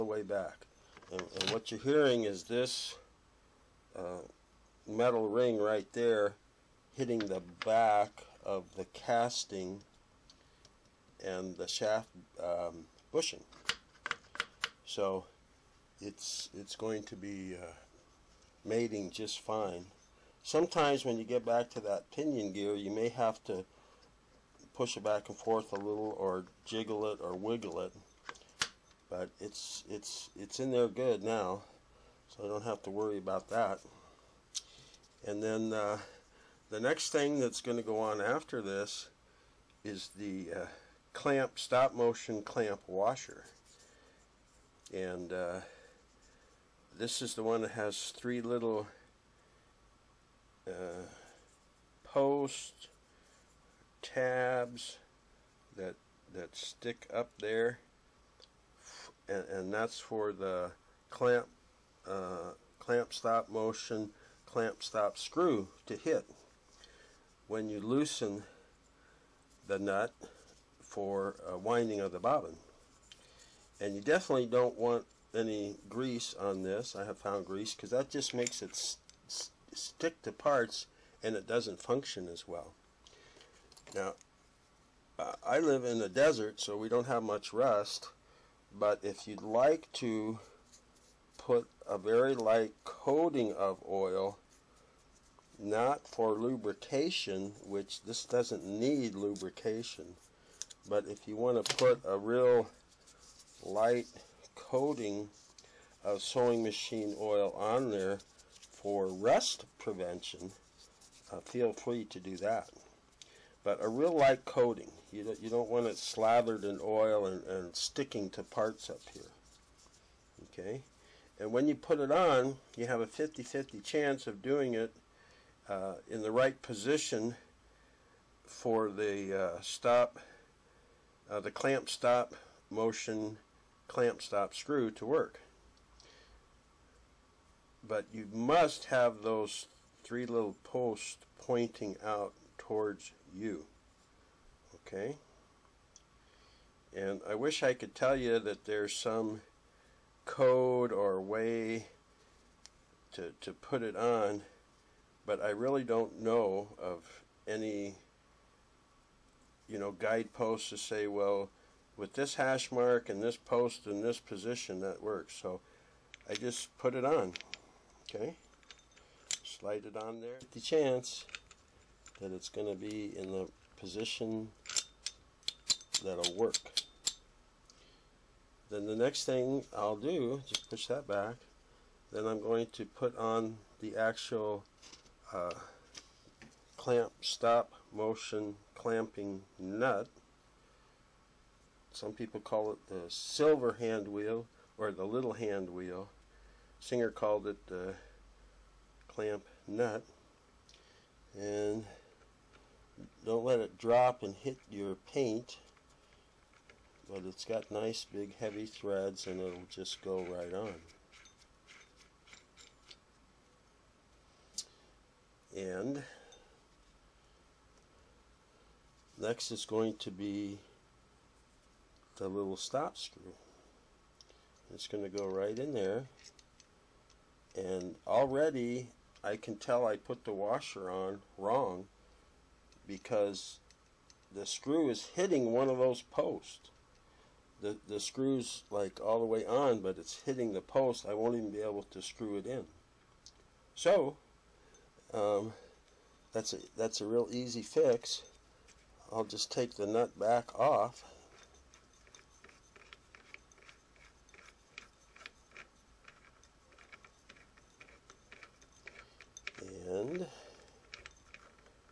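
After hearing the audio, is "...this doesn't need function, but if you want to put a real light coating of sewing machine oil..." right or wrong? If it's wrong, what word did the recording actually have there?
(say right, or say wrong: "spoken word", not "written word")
wrong: "lubrication", not "function".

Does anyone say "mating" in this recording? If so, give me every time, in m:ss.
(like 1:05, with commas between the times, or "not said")
0:18.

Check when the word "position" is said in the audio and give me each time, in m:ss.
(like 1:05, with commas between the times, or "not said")
2:06, 2:44, 2:53.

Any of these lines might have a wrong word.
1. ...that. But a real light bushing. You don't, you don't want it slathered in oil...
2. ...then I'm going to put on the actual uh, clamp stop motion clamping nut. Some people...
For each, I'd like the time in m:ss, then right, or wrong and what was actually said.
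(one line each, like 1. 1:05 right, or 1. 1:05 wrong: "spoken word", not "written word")
1. 1:52 wrong: "coating", not "bushing"
2. 3:02 right.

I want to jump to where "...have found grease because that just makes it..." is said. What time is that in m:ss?
1:17.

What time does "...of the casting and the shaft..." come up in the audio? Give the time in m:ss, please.
0:08.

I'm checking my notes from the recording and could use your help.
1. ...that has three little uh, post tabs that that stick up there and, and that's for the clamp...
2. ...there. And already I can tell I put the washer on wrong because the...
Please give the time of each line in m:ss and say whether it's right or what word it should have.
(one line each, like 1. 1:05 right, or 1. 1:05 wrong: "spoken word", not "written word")
1. 0:47 right
2. 3:45 right.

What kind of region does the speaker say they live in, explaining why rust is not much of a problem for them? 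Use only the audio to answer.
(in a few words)
The desert.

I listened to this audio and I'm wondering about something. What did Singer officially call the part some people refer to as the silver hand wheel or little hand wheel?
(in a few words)
Clamp nut.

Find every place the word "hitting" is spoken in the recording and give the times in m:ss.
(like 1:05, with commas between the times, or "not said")
0:06, 3:55, 4:00.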